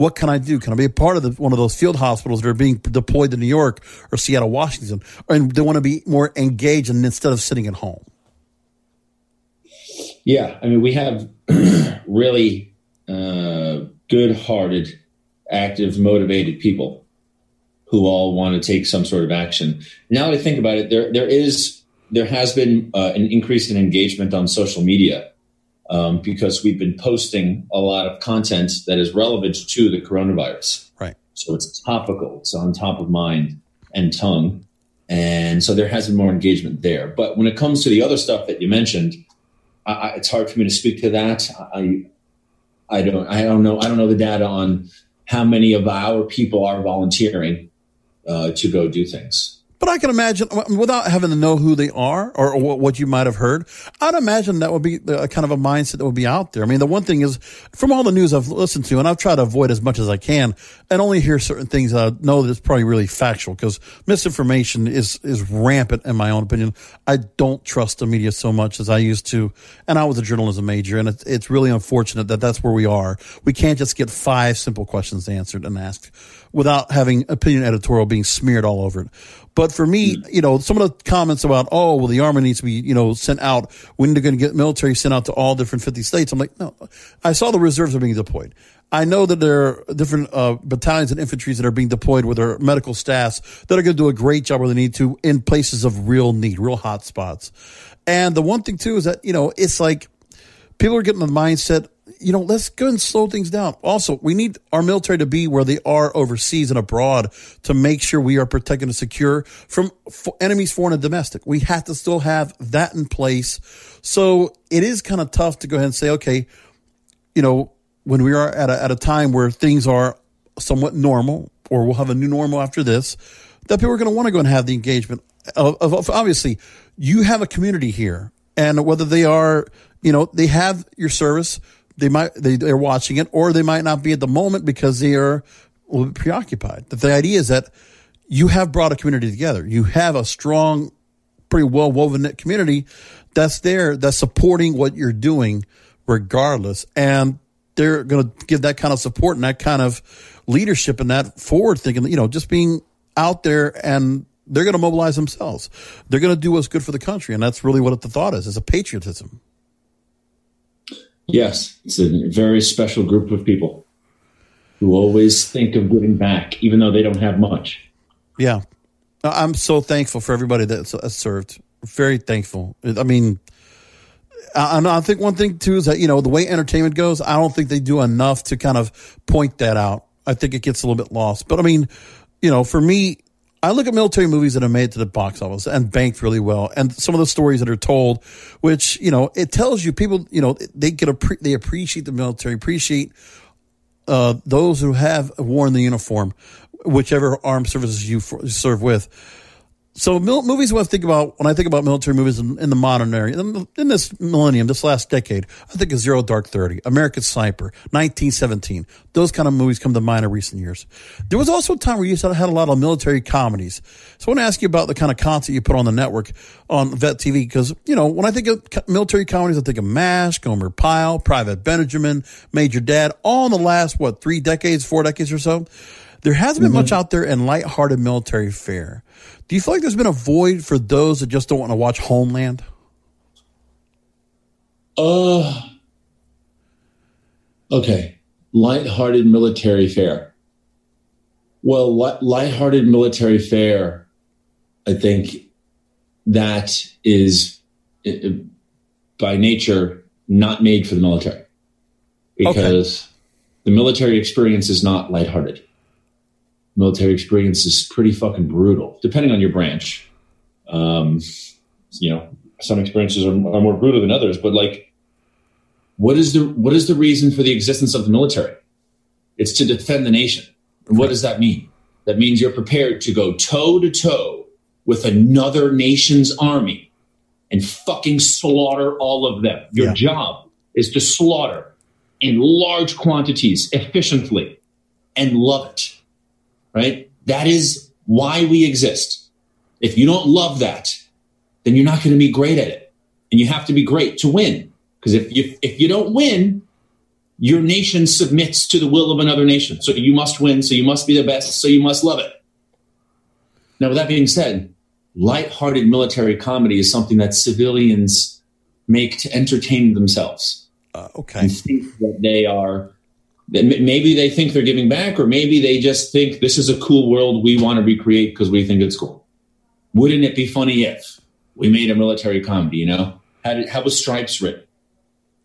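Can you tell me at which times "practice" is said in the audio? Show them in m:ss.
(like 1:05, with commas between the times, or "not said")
not said.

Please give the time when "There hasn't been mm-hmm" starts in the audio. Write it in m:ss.
3:46.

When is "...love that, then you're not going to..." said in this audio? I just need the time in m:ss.
4:50.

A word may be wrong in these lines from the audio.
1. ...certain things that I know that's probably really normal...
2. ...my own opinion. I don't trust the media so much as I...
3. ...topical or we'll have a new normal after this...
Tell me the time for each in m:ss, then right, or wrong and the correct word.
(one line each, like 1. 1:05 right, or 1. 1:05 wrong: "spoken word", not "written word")
1. 1:01 wrong: "factual", not "normal"
2. 1:06 right
3. 2:00 wrong: "normal", not "topical".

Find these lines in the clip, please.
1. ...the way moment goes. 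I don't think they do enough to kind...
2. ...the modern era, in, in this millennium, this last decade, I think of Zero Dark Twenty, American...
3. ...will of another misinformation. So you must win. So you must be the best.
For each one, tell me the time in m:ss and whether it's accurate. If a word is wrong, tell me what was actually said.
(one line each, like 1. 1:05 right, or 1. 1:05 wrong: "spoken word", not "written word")
1. 2:56 wrong: "entertainment", not "moment"
2. 3:22 wrong: "Thirty", not "Twenty"
3. 4:58 wrong: "nation", not "misinformation".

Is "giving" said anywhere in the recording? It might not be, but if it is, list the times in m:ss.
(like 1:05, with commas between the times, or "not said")
2:45, 5:14.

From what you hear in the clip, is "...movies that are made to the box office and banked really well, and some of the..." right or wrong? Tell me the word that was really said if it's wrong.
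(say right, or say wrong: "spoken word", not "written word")
right.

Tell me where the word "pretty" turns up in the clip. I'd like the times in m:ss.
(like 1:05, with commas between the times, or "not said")
2:21, 4:17.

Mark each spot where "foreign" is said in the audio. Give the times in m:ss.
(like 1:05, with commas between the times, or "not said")
1:50.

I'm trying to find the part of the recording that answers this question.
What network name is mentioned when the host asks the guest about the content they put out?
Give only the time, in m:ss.
3:36.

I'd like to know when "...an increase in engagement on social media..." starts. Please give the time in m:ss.
0:23.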